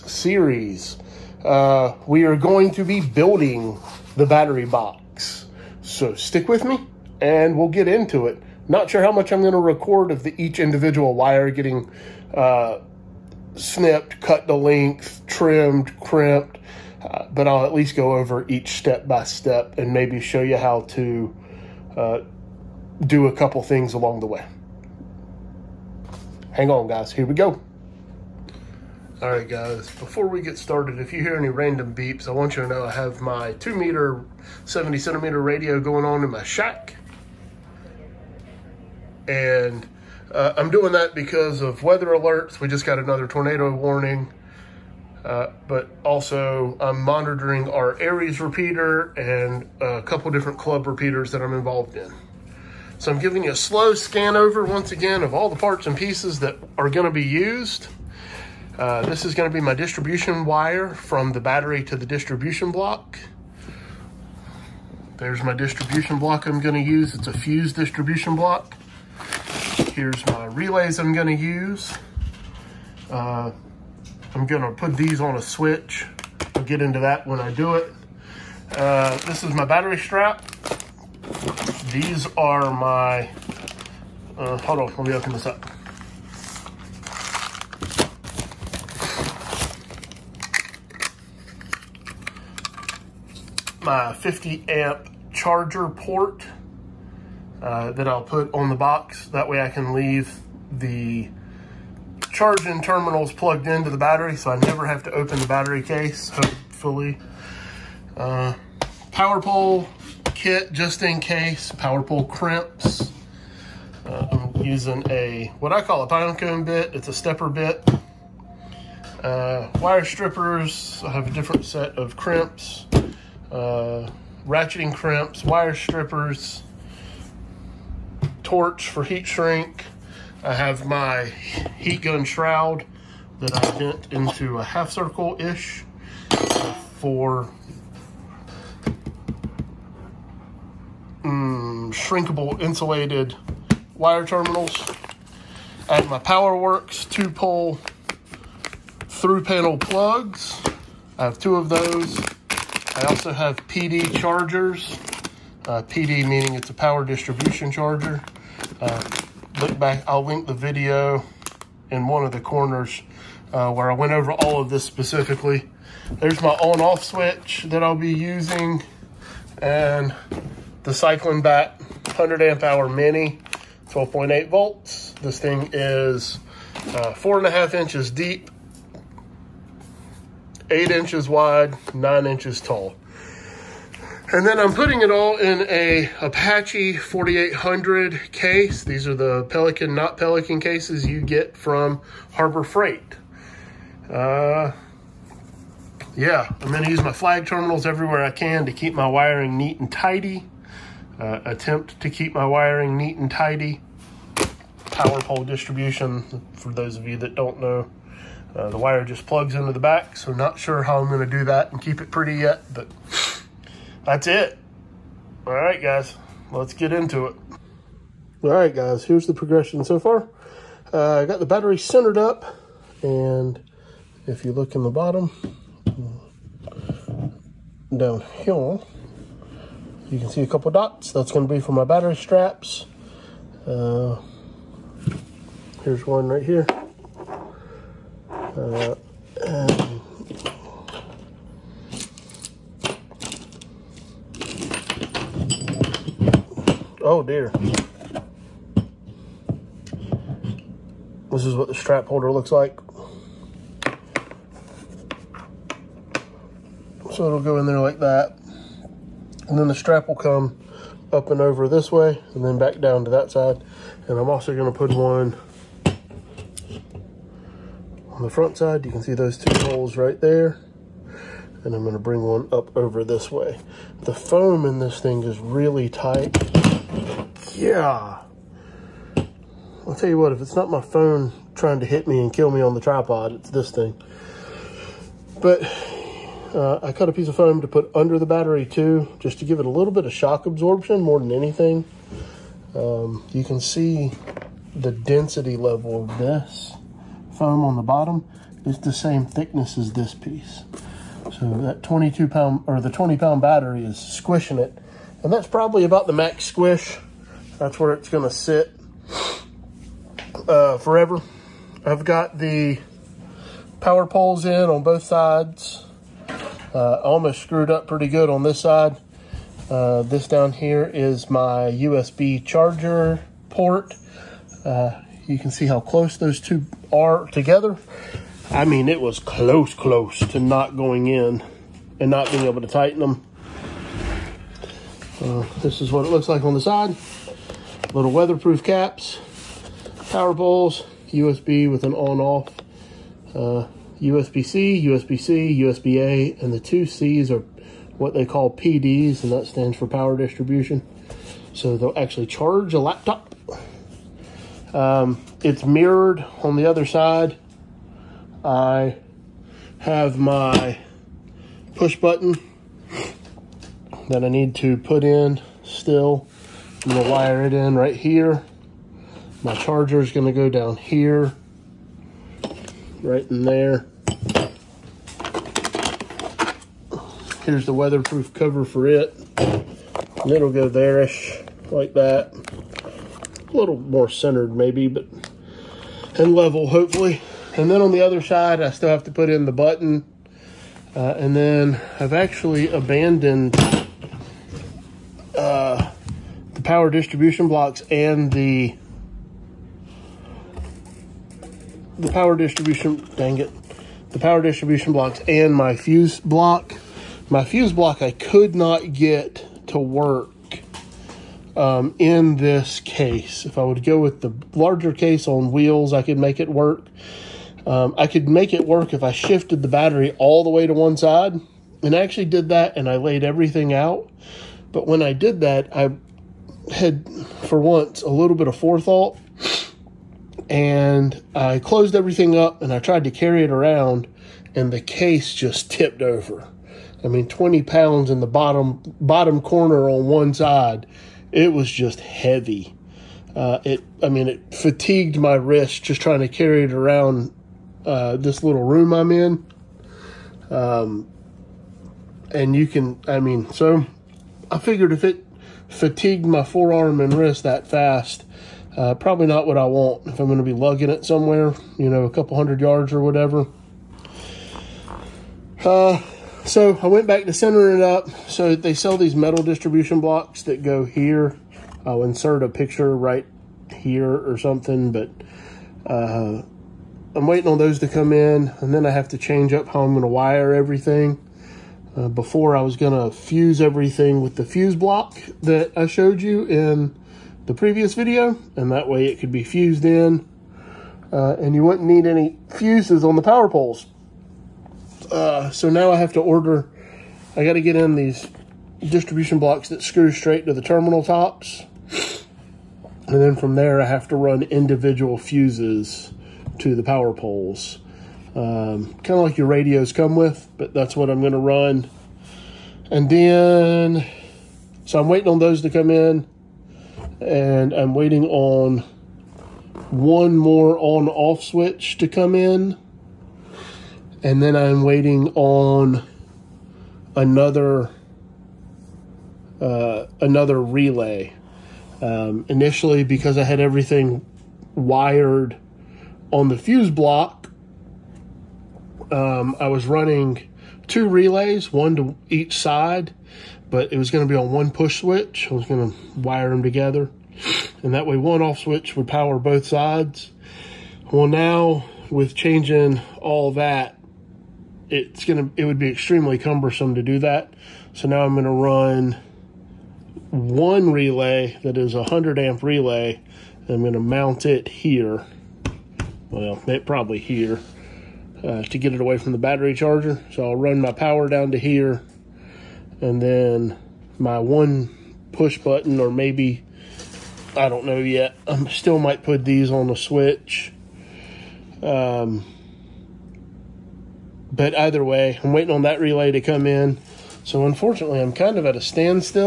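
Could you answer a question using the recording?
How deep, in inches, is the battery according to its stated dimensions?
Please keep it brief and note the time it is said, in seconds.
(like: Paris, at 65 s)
4.5 inches, at 177 s.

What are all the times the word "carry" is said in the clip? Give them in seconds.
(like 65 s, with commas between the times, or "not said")
433 s, 446 s.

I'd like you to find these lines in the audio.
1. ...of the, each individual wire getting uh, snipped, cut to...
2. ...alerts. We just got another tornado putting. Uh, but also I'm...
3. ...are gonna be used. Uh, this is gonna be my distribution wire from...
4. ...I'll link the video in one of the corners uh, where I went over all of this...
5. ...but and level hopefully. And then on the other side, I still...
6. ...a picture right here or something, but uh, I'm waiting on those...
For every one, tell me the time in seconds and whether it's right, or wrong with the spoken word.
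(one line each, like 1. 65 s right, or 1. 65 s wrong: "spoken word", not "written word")
1. 10 s right
2. 42 s wrong: "warning", not "putting"
3. 56 s right
4. 160 s right
5. 384 s right
6. 472 s right.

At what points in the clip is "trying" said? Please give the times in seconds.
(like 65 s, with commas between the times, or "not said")
281 s, 445 s.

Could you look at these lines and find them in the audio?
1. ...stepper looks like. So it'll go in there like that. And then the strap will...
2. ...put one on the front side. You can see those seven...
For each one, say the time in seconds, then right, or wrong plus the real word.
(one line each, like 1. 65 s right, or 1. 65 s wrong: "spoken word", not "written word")
1. 252 s wrong: "holder", not "stepper"
2. 264 s wrong: "two", not "seven".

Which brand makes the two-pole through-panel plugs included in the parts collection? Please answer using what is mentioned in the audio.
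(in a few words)
Powerwerx.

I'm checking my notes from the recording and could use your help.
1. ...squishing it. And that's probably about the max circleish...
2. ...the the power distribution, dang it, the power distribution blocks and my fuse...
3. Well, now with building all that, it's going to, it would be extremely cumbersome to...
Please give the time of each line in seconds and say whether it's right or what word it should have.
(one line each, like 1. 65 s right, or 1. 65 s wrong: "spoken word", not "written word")
1. 303 s wrong: "squish", not "circleish"
2. 398 s right
3. 551 s wrong: "changing", not "building".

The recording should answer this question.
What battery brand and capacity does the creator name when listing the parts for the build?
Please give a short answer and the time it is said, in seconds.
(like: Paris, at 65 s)
Cycling Bat 100 amp hour, at 170 s.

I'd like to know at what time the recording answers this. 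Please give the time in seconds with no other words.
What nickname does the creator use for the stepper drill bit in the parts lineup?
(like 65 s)
116 s.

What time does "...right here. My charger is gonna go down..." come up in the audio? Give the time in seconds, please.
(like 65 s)
367 s.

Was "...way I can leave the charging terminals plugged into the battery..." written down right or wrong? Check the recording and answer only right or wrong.
right.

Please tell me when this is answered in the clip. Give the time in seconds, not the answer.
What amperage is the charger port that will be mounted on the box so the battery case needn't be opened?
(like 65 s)
94 s.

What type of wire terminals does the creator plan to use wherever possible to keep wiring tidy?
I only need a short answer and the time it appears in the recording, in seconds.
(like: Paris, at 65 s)
flag terminals, at 197 s.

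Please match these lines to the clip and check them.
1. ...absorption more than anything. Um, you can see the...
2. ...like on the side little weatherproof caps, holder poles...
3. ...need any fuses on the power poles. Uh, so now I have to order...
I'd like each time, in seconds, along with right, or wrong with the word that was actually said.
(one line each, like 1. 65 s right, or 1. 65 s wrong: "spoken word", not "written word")
1. 290 s right
2. 336 s wrong: "power", not "holder"
3. 491 s right.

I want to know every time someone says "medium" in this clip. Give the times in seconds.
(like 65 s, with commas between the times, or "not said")
not said.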